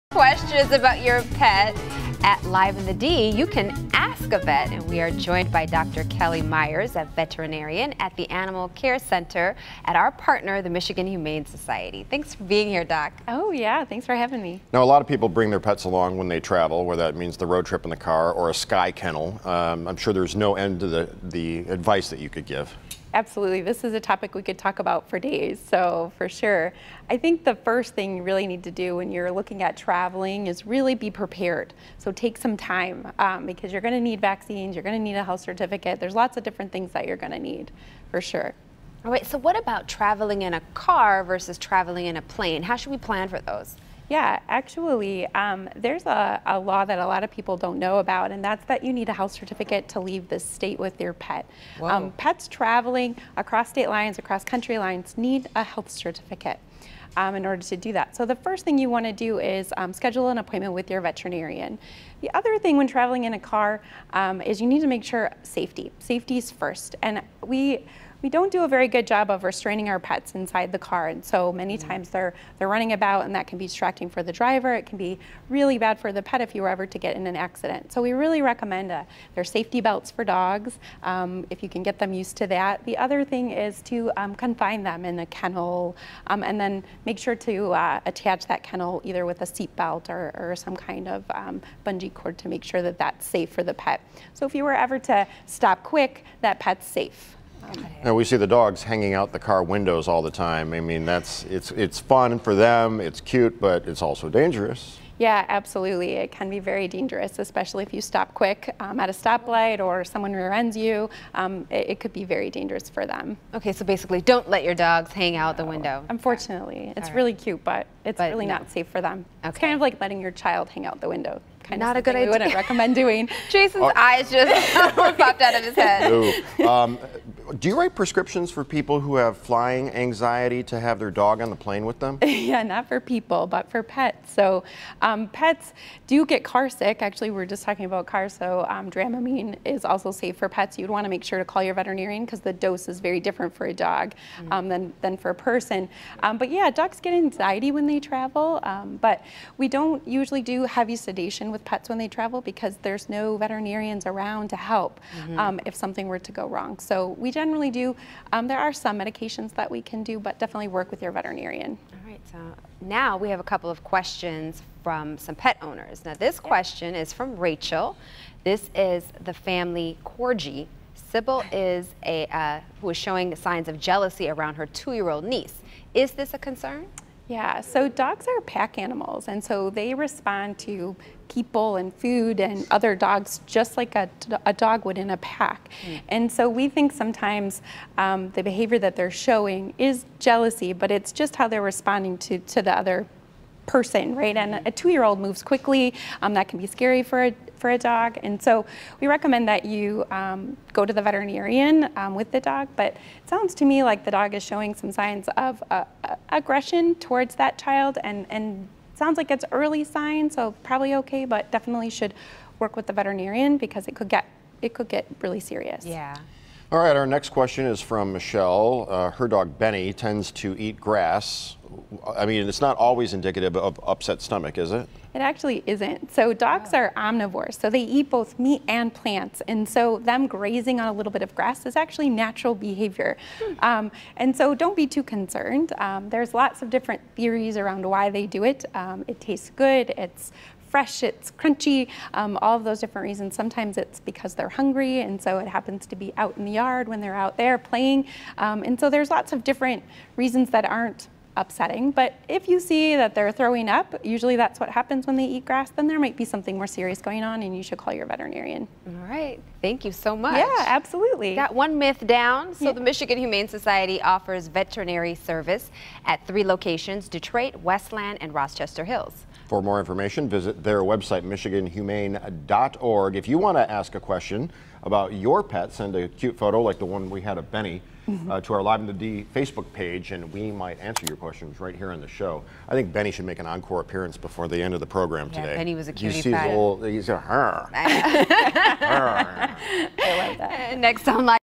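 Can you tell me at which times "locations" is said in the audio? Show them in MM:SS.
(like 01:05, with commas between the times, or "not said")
04:26.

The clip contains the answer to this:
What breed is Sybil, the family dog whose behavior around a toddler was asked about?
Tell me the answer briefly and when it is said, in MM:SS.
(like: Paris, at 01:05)
Corgi, at 02:50.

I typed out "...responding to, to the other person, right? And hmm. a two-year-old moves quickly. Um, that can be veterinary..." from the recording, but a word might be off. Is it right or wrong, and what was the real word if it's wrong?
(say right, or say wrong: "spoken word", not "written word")
wrong: "scary", not "veterinary".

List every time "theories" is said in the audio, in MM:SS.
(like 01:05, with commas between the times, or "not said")
03:57.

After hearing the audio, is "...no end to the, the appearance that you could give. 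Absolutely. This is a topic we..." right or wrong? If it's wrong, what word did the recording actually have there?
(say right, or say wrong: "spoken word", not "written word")
wrong: "advice", not "appearance".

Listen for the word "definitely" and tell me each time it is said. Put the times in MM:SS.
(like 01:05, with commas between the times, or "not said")
02:40, 03:31.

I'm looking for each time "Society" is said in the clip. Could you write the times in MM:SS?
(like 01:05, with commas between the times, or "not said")
00:11, 04:23.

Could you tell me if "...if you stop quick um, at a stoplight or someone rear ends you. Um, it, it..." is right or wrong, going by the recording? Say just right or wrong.
right.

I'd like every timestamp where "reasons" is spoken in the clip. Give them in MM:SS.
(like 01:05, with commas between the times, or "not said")
04:03, 04:10.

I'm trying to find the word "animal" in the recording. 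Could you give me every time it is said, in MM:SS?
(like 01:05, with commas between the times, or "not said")
00:08, 02:58.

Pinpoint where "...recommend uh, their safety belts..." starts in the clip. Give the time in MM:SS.
01:18.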